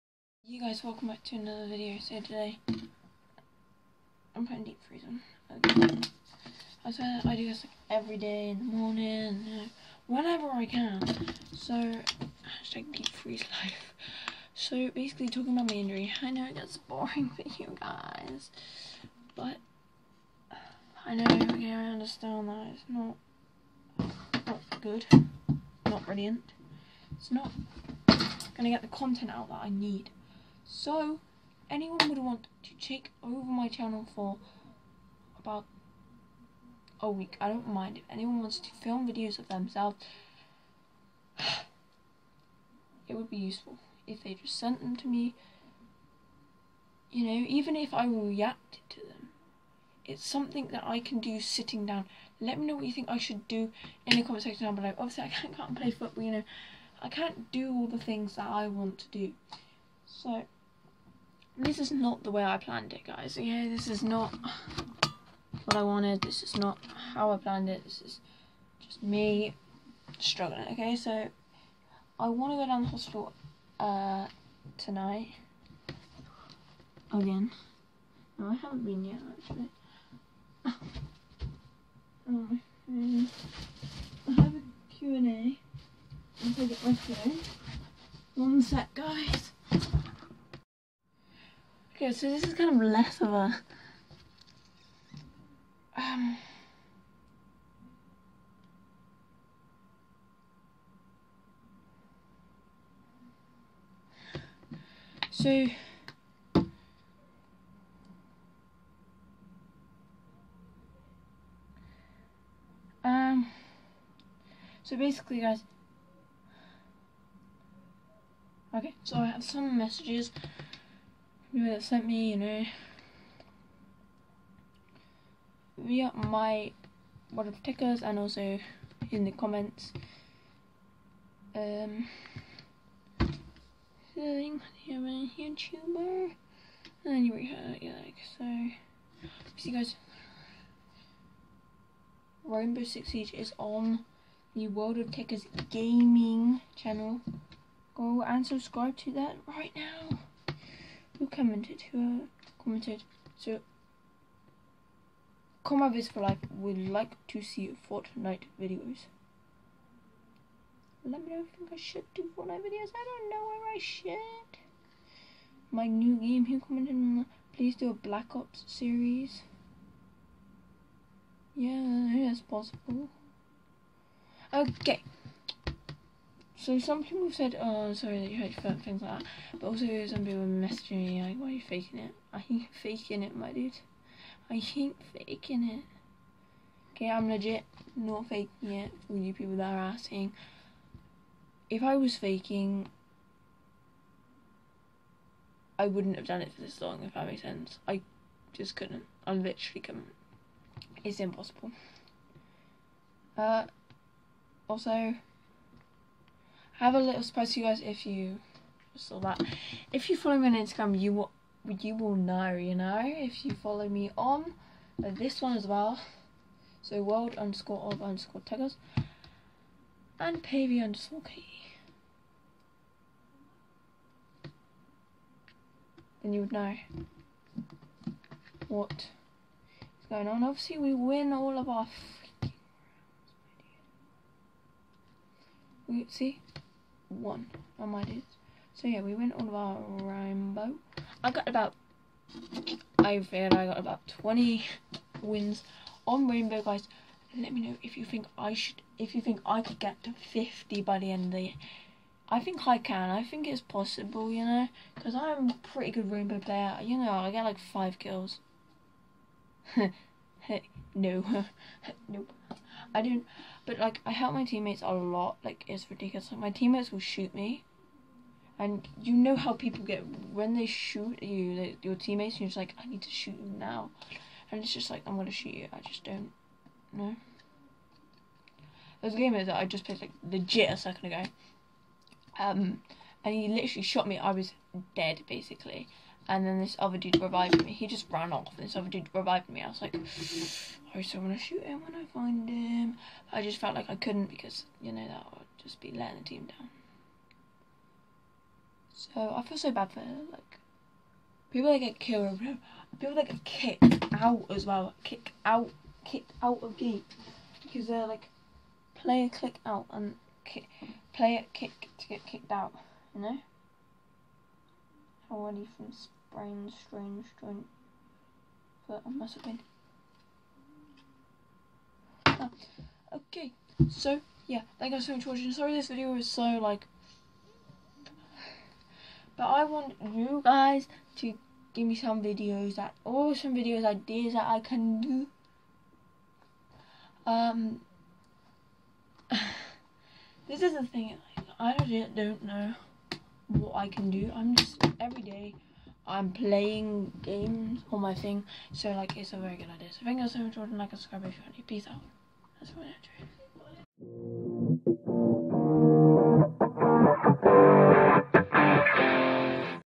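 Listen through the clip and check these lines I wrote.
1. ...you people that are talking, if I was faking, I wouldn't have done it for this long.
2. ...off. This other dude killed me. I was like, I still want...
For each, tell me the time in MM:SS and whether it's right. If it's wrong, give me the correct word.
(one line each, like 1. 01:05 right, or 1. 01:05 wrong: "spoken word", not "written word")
1. 03:09 wrong: "asking", not "talking"
2. 04:48 wrong: "revived", not "killed".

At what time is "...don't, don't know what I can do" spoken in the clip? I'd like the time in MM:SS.
05:41.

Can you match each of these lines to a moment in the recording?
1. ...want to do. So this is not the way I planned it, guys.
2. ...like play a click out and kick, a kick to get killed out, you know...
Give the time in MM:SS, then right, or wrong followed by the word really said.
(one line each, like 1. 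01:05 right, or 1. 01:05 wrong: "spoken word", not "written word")
1. 00:58 right
2. 05:08 wrong: "kicked", not "killed".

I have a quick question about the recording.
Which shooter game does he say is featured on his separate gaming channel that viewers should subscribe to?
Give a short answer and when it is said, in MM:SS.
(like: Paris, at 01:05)
Rainbow Six Siege, at 02:22.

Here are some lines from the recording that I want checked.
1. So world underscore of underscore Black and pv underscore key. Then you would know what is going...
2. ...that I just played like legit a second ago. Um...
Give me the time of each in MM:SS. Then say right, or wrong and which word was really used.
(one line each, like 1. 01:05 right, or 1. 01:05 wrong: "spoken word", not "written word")
1. 03:36 wrong: "Tekkerz", not "Black"
2. 04:39 right.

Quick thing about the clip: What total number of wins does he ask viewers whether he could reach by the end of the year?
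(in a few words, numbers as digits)
50.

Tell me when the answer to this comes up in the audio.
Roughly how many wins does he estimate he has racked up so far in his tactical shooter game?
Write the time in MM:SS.
04:04.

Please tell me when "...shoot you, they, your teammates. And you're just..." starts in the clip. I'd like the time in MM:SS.
04:30.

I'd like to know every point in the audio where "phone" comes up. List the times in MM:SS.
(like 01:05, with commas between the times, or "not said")
01:26.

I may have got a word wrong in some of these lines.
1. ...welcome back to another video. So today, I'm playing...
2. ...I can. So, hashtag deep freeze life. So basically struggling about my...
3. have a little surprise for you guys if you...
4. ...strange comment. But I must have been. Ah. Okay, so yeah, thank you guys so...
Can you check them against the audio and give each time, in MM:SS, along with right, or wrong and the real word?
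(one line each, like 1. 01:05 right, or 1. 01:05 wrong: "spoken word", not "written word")
1. 00:00 wrong: "putting", not "playing"
2. 00:10 wrong: "talking", not "struggling"
3. 03:26 right
4. 05:16 wrong: "joint", not "comment".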